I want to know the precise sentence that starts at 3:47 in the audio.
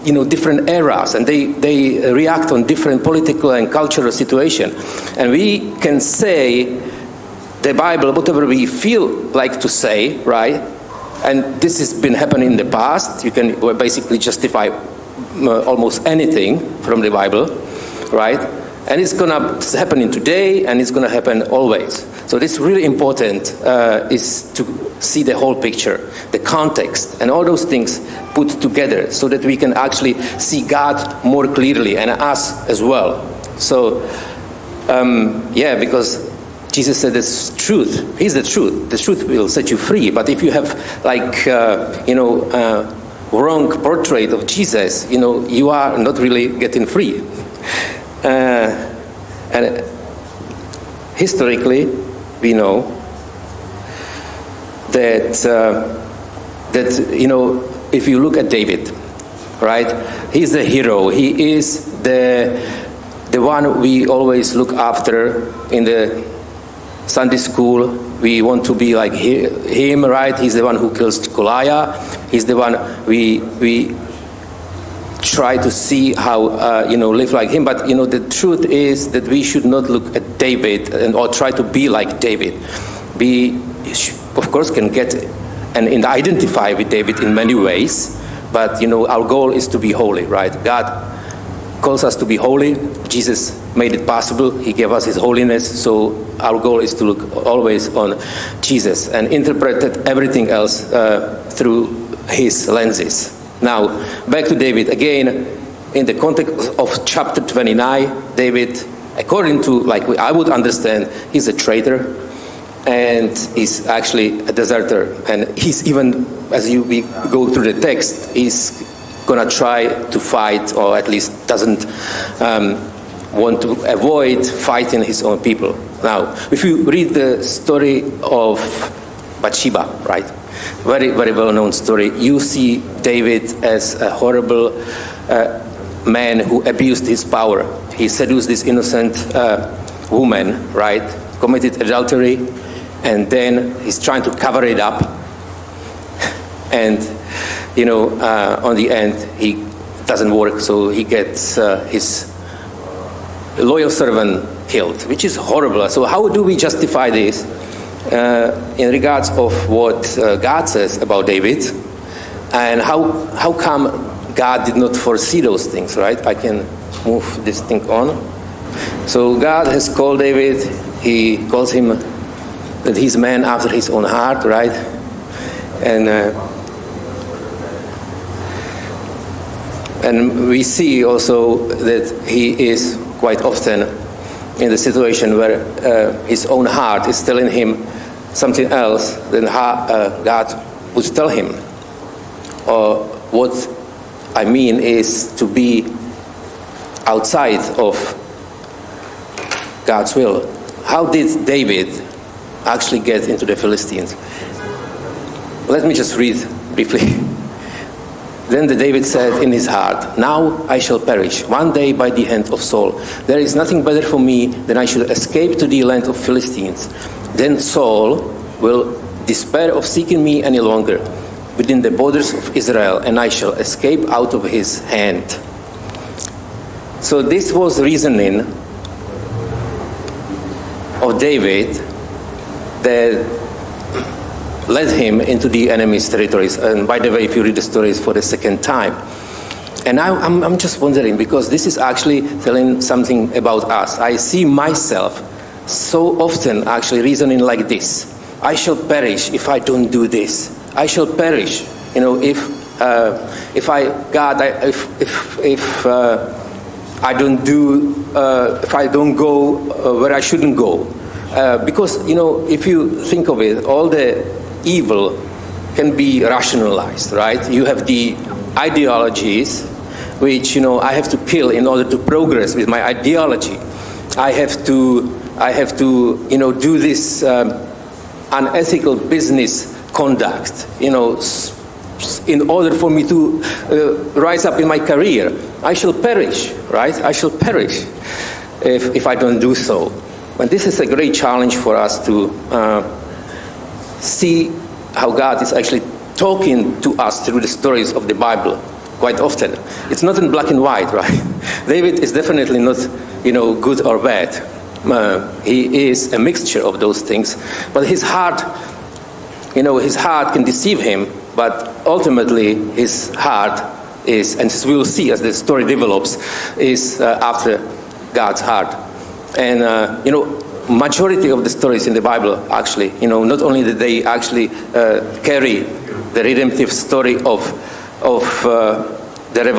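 So this was reasoning of David that led him into the enemy's territories.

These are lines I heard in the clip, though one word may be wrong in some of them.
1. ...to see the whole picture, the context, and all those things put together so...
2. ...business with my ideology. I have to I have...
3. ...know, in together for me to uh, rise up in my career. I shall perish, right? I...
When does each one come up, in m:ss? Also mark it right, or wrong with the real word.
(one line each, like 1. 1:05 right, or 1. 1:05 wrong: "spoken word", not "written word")
1. 0:24 right
2. 4:31 wrong: "progress", not "business"
3. 4:40 wrong: "order", not "together".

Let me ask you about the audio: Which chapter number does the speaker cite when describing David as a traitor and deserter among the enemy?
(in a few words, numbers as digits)
29.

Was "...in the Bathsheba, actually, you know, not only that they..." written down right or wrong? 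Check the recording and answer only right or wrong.
wrong.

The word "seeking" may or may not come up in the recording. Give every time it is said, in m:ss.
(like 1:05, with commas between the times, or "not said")
3:39.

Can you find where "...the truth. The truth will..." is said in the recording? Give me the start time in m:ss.
0:38.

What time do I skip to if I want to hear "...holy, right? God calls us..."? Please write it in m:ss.
1:29.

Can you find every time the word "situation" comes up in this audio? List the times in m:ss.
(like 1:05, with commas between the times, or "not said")
0:04, 3:04.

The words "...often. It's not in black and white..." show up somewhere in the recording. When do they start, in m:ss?
4:59.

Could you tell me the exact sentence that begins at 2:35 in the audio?
So how do we justify this?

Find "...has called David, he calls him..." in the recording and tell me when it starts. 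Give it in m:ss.
2:49.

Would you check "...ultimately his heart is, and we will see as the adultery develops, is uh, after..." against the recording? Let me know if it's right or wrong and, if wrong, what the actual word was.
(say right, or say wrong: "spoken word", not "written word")
wrong: "story", not "adultery".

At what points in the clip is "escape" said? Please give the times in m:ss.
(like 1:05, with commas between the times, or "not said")
3:35, 3:43.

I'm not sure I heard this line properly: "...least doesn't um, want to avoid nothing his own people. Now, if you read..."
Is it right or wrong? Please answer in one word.
wrong.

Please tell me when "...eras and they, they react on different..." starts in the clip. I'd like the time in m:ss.
0:00.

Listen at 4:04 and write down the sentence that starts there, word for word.
I see myself so often actually reasoning like this I shall perish if I don't do this.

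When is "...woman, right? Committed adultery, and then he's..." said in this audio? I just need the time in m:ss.
2:20.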